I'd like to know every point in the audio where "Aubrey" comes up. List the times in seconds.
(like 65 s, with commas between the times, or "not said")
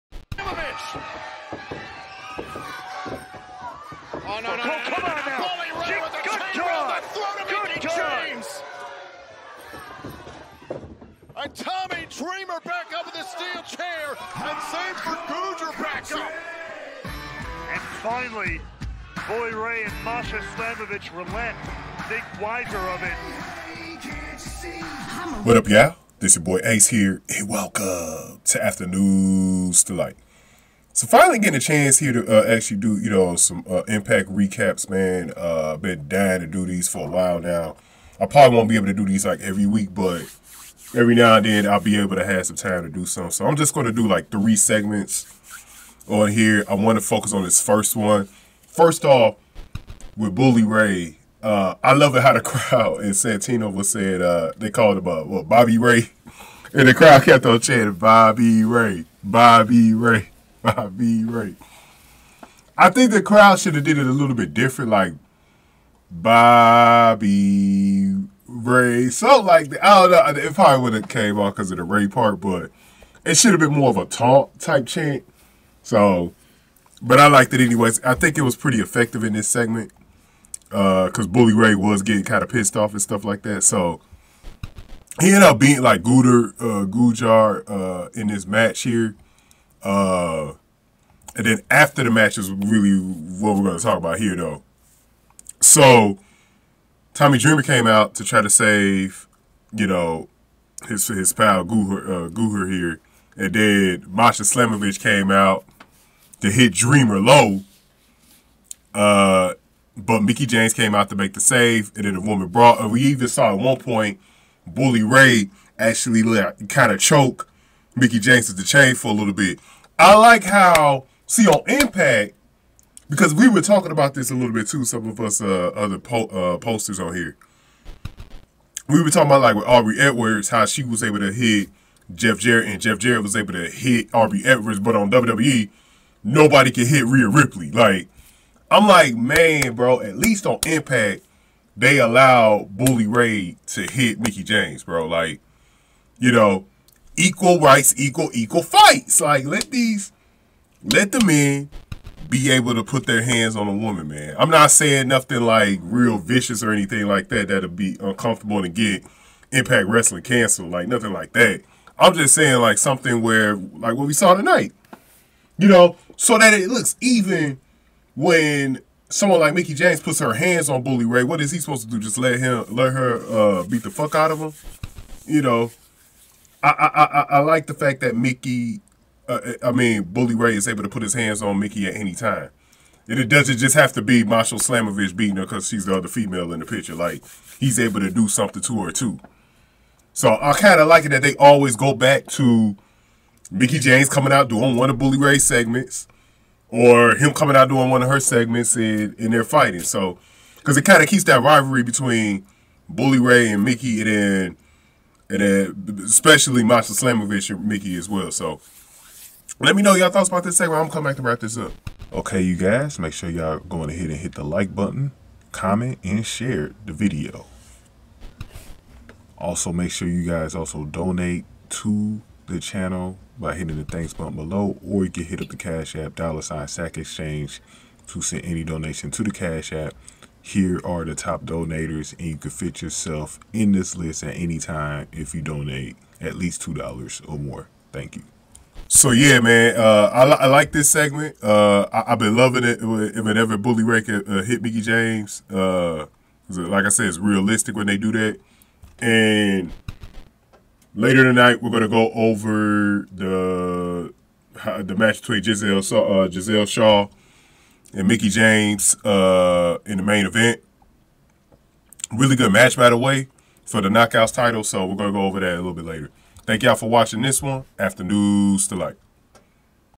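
129 s, 134 s.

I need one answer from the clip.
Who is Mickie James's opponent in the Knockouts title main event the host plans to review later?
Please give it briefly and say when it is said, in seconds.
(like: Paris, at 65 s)
Gisele Shaw, at 256 s.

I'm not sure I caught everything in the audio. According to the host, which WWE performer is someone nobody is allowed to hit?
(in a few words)
Rhea Ripley.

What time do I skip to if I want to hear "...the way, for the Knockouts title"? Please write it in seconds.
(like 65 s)
262 s.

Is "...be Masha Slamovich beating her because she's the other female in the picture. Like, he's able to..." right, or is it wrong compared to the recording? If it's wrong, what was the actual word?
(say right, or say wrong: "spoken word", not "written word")
right.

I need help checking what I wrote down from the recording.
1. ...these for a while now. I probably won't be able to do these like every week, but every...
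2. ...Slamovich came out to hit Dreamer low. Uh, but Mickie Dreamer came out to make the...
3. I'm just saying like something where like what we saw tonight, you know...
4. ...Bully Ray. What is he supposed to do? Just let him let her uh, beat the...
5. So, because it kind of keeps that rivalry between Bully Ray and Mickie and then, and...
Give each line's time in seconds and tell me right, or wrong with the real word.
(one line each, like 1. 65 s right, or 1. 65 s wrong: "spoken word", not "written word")
1. 36 s right
2. 104 s wrong: "James", not "Dreamer"
3. 161 s right
4. 170 s right
5. 199 s right.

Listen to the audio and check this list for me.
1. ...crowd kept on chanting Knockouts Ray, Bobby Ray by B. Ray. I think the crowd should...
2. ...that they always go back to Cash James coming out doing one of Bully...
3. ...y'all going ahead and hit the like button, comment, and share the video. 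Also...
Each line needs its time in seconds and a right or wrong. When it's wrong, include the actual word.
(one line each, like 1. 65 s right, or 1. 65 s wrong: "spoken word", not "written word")
1. 56 s wrong: "Bobby", not "Knockouts"
2. 191 s wrong: "Mickie", not "Cash"
3. 213 s right.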